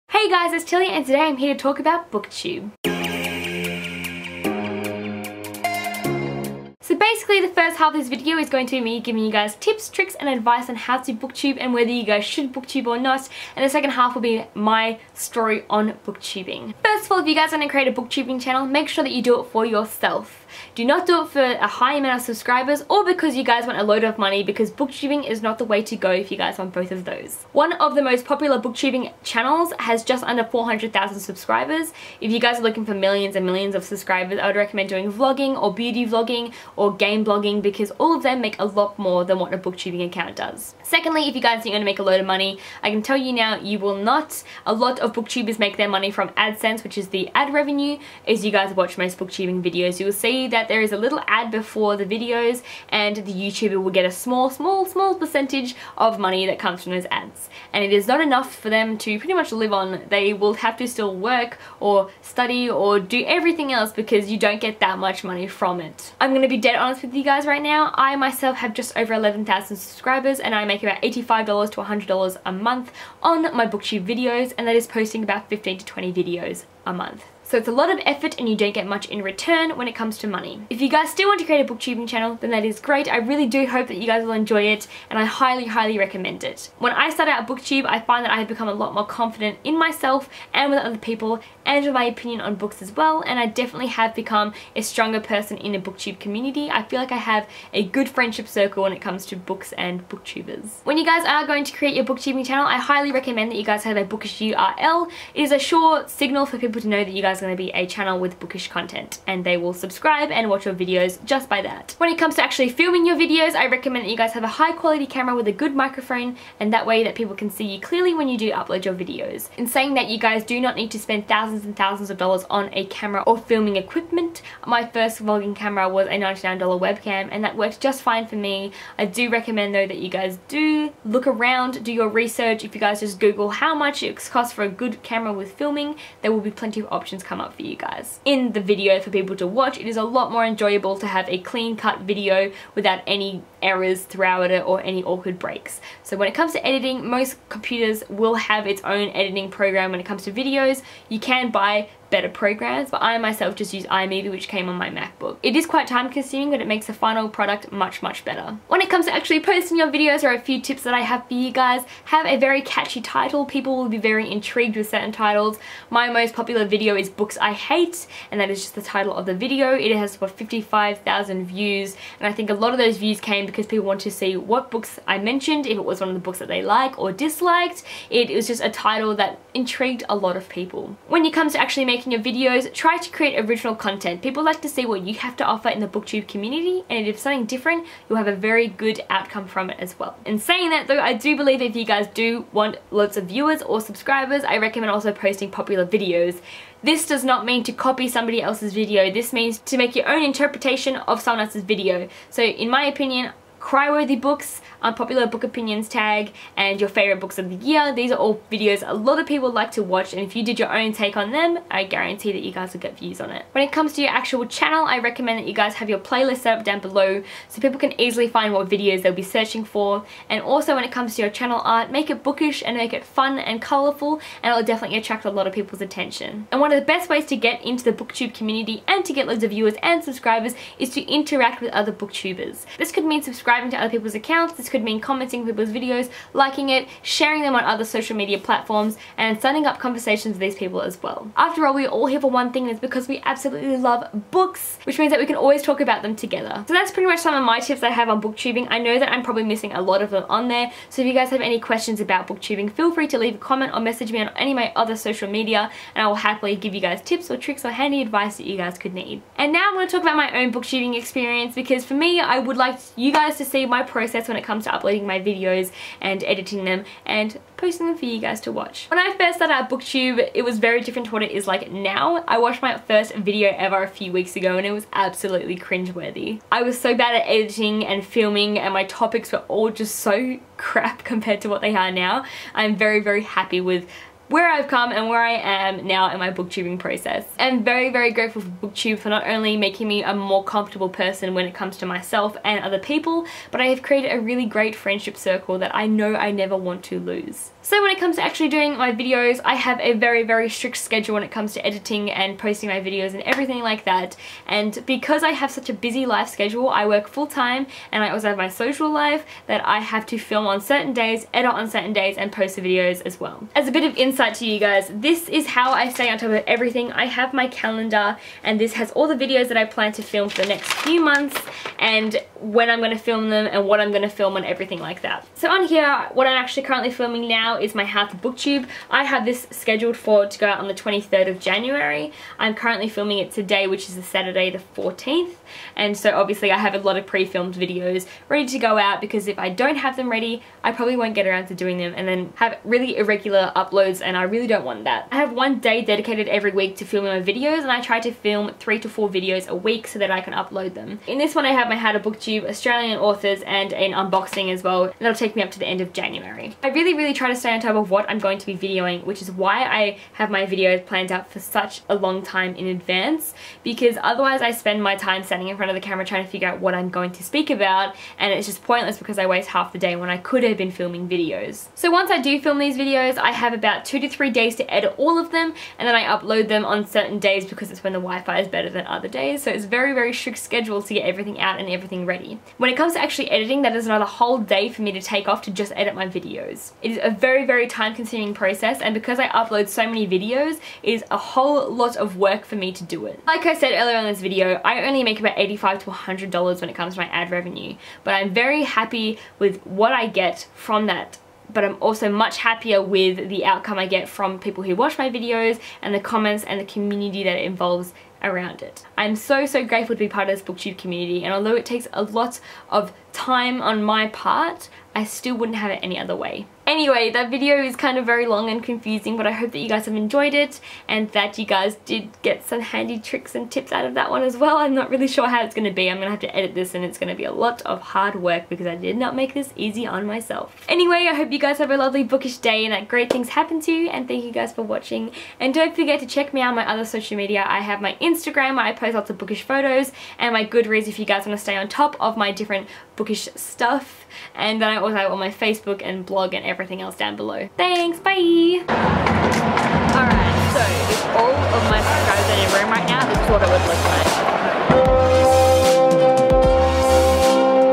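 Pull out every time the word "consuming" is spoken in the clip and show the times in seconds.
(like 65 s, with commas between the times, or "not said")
156 s, 387 s.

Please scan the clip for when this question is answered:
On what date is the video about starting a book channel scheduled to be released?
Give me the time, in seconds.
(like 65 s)
330 s.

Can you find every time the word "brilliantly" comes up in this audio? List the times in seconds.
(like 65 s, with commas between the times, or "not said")
not said.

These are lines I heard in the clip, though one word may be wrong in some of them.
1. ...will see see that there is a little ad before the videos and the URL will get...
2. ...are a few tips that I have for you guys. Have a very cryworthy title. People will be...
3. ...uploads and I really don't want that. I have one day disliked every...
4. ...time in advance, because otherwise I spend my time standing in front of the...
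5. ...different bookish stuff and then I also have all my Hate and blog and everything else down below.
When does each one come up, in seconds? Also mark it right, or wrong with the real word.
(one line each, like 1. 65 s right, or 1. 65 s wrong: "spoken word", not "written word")
1. 50 s wrong: "YouTuber", not "URL"
2. 160 s wrong: "catchy", not "cryworthy"
3. 343 s wrong: "dedicated", not "disliked"
4. 362 s right
5. 442 s wrong: "Facebook", not "Hate".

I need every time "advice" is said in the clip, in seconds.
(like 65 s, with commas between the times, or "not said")
10 s, 258 s.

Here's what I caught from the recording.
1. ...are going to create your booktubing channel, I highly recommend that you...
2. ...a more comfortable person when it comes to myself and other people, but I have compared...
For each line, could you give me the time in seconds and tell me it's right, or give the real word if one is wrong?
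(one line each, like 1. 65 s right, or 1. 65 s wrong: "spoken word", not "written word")
1. 101 s right
2. 290 s wrong: "created", not "compared".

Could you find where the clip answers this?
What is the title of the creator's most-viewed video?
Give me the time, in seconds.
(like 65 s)
167 s.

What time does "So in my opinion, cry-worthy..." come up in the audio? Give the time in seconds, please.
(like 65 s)
202 s.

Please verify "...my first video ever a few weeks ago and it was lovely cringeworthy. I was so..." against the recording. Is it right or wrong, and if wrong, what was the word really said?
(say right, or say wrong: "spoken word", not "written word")
wrong: "absolutely", not "lovely".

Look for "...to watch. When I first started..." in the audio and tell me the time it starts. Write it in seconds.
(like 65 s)
268 s.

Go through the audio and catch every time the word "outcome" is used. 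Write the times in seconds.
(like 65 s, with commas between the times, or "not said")
189 s, 403 s.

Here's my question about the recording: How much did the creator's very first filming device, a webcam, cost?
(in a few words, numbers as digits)
$99.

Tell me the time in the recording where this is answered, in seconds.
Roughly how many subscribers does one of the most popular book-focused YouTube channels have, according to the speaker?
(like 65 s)
30 s.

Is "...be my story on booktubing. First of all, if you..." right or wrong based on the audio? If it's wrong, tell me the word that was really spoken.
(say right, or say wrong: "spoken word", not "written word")
right.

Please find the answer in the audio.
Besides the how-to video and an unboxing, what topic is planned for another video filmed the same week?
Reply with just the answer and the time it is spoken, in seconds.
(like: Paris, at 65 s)
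Australian authors, at 352 s.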